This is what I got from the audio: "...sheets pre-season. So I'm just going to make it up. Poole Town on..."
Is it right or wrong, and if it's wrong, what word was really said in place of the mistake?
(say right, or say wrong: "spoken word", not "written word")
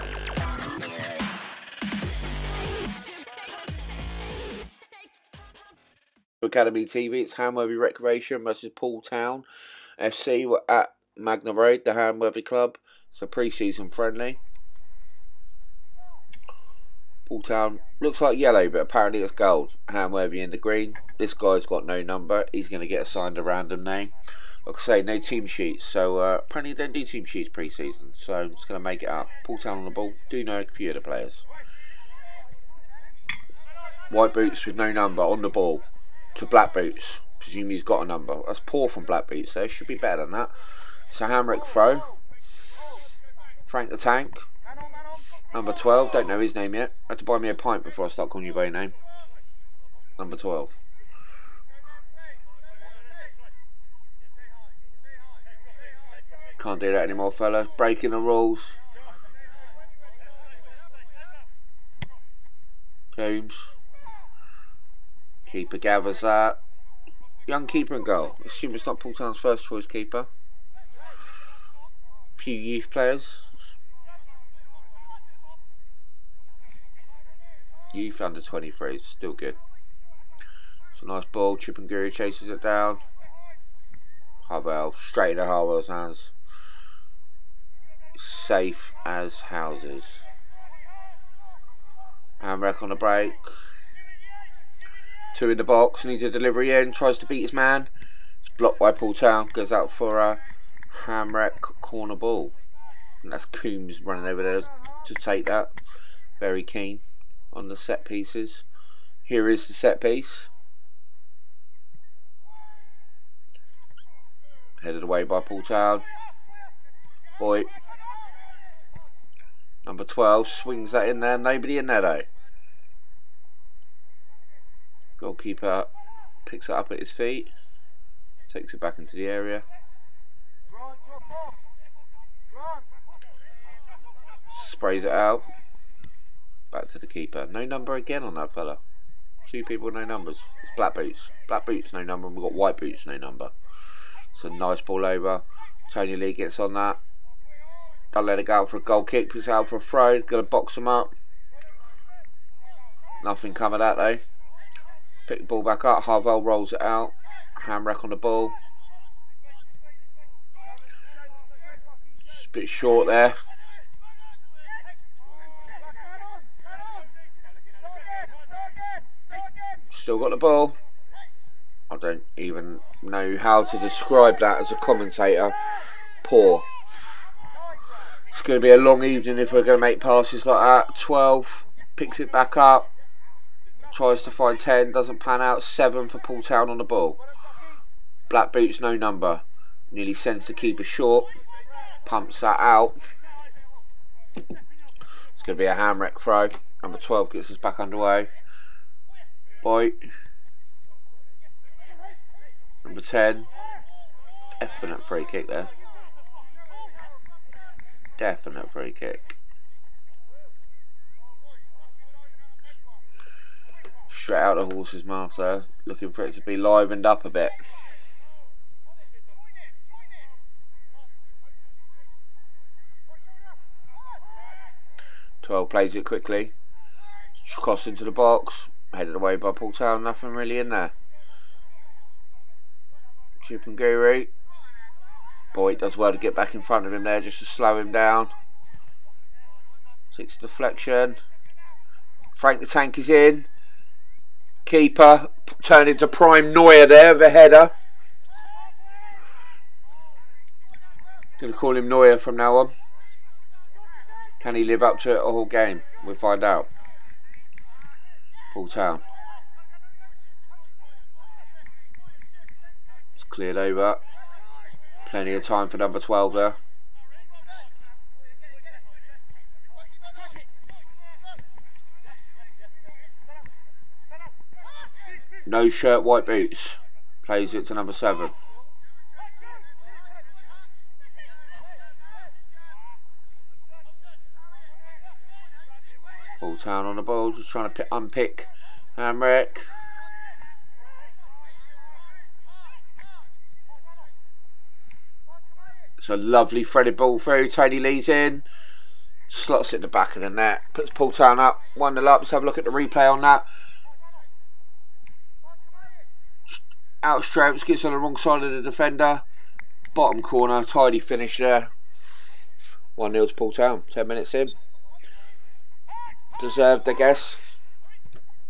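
right.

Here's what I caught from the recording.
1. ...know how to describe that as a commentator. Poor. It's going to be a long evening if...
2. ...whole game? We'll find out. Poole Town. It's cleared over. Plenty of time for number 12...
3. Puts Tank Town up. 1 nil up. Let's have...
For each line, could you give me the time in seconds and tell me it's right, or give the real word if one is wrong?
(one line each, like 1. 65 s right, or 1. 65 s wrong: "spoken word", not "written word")
1. 173 s right
2. 255 s right
3. 300 s wrong: "Poole", not "Tank".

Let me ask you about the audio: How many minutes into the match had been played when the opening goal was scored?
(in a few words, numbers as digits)
10.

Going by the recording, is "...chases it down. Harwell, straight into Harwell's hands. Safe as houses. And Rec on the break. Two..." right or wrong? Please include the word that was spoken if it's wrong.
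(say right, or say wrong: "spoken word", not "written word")
right.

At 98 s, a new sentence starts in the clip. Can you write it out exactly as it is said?
It's blocked by Poole Town, goes out for a Ham Rec corner ball.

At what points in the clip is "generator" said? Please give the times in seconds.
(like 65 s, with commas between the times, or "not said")
not said.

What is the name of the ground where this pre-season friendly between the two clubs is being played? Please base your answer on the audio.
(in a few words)
Magna Road.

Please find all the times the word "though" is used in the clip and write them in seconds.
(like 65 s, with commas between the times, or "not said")
39 s, 122 s, 153 s.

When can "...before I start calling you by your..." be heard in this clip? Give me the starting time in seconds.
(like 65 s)
47 s.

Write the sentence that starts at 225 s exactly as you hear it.
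Twelve plays it quickly, cross into the box, headed away by Poole Town, nothing really in there.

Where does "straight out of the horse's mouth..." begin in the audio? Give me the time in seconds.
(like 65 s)
214 s.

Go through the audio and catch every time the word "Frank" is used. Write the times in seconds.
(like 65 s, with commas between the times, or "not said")
43 s, 242 s.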